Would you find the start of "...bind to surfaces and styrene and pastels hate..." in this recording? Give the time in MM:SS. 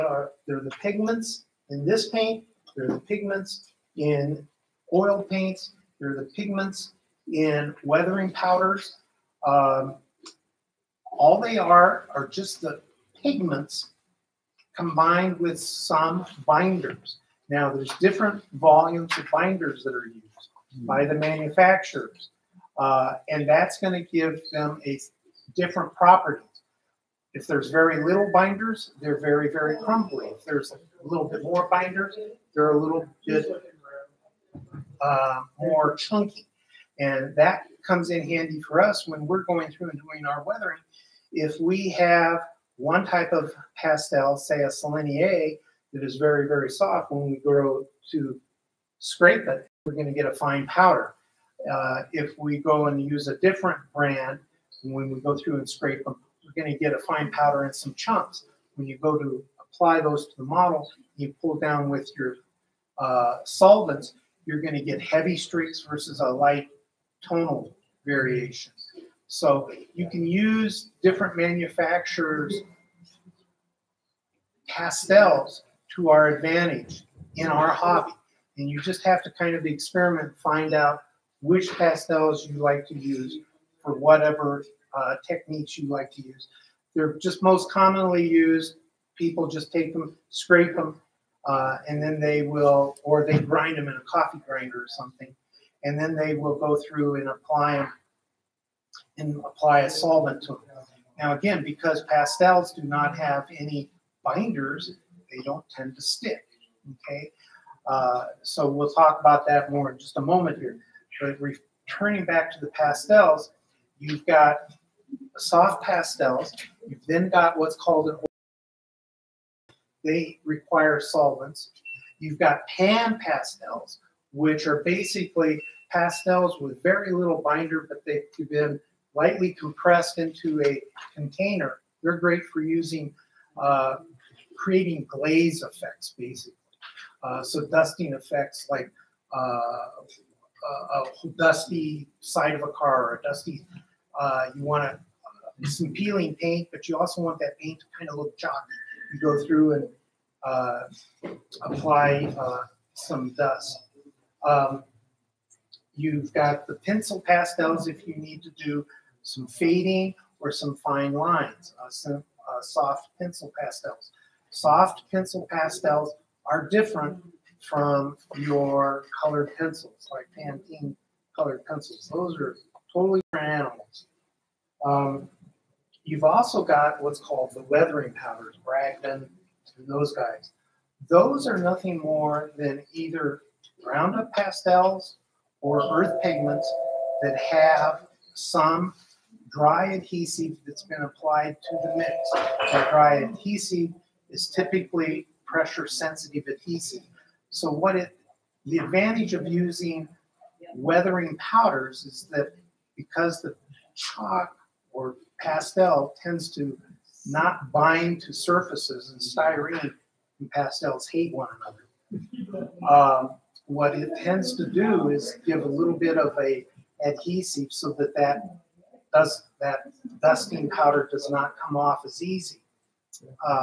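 03:27.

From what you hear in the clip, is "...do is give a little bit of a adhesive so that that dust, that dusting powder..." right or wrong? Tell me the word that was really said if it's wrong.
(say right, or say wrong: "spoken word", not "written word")
right.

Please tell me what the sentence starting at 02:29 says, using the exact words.
You go through and uh, apply uh, some dust.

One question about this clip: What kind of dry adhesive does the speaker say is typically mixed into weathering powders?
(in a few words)
pressure sensitive adhesive.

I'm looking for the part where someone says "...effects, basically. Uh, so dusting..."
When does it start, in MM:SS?
02:15.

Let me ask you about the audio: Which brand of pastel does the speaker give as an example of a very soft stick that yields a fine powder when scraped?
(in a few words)
Sennelier.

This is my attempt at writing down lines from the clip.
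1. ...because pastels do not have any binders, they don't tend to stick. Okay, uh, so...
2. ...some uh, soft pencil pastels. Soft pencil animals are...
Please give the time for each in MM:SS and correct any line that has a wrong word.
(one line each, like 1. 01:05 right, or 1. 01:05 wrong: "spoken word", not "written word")
1. 01:41 right
2. 02:41 wrong: "pastels", not "animals".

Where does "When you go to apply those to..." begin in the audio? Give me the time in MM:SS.
00:58.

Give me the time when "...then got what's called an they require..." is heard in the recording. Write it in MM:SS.
01:57.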